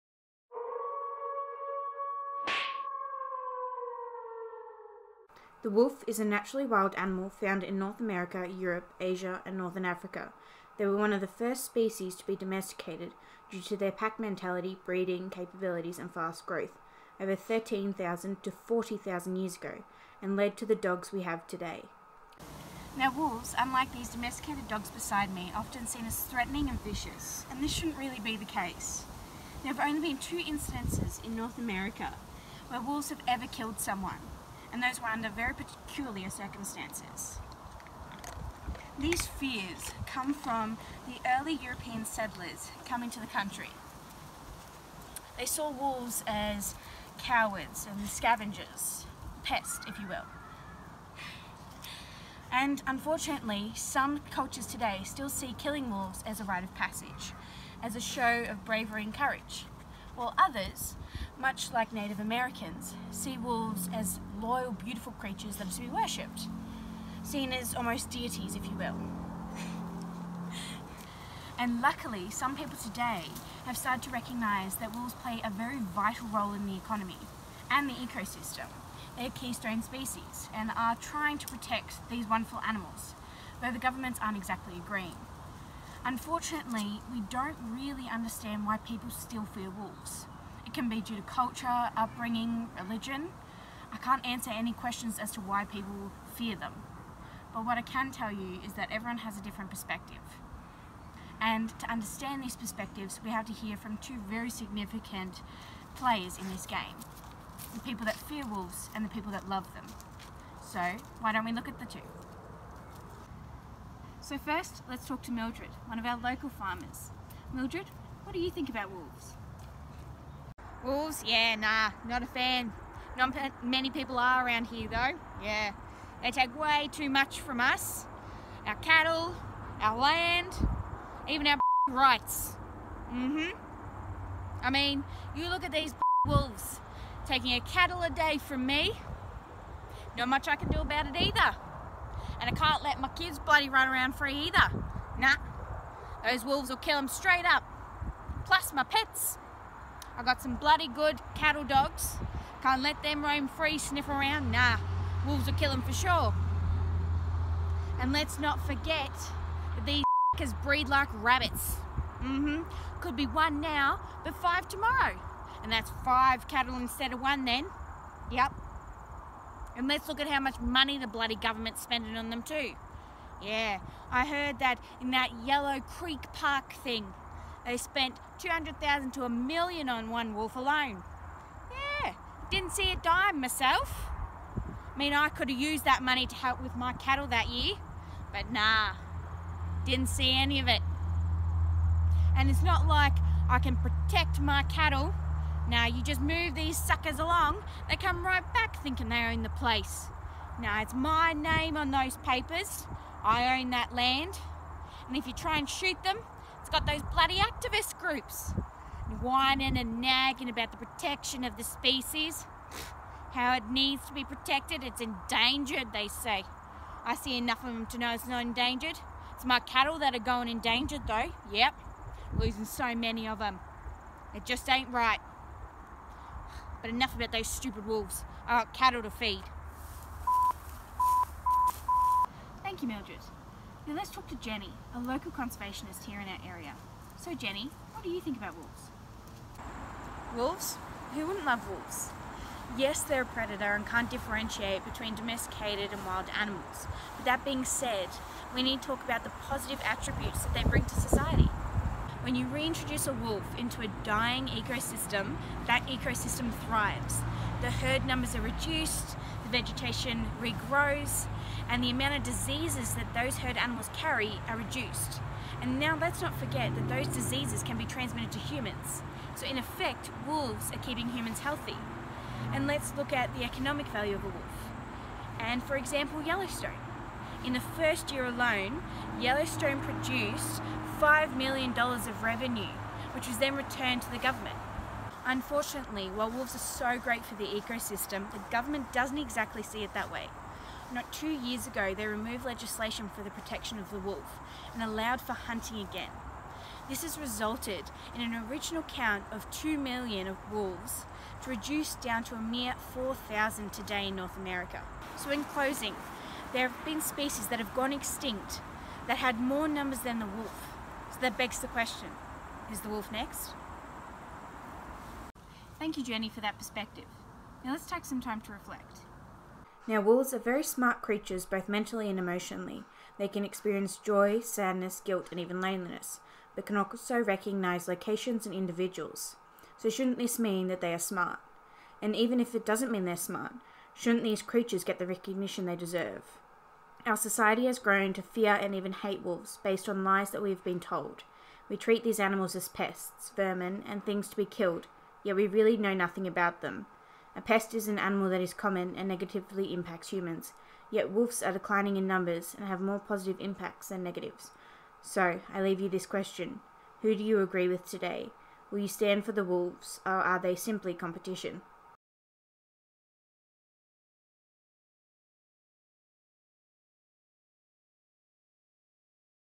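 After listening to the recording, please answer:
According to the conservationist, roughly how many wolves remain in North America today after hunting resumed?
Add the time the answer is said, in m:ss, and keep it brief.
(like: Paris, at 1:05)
4,000, at 5:02.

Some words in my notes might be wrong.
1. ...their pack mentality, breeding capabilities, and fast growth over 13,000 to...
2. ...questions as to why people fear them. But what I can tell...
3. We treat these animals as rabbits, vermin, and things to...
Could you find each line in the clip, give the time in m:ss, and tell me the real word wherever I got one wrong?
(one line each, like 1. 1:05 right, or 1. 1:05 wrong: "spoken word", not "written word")
1. 0:13 right
2. 1:34 right
3. 5:41 wrong: "pests", not "rabbits".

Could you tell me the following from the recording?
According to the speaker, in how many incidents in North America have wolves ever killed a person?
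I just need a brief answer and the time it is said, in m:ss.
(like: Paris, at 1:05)
2, at 0:30.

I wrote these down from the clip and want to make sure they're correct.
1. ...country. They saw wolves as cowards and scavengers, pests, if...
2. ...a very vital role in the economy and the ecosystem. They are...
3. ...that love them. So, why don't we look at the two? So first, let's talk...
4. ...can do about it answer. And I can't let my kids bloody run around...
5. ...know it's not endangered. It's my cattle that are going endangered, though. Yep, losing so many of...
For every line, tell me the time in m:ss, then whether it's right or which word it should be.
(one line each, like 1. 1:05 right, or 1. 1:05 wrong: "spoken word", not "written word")
1. 0:43 right
2. 1:15 right
3. 1:49 right
4. 2:20 wrong: "either", not "answer"
5. 3:37 right.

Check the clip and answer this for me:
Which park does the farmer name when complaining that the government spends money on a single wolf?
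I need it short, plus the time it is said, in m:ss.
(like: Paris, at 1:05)
Yellow Creek Park, at 2:55.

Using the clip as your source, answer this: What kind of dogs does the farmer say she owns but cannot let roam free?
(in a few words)
Cattle dogs.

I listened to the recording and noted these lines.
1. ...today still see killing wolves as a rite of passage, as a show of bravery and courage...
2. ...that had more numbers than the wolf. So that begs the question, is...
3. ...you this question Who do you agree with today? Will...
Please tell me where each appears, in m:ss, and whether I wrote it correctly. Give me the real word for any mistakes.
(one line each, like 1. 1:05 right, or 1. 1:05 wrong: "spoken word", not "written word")
1. 0:54 right
2. 5:09 right
3. 5:55 right.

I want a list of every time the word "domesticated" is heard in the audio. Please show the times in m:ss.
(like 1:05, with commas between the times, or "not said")
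0:12, 0:24, 4:05.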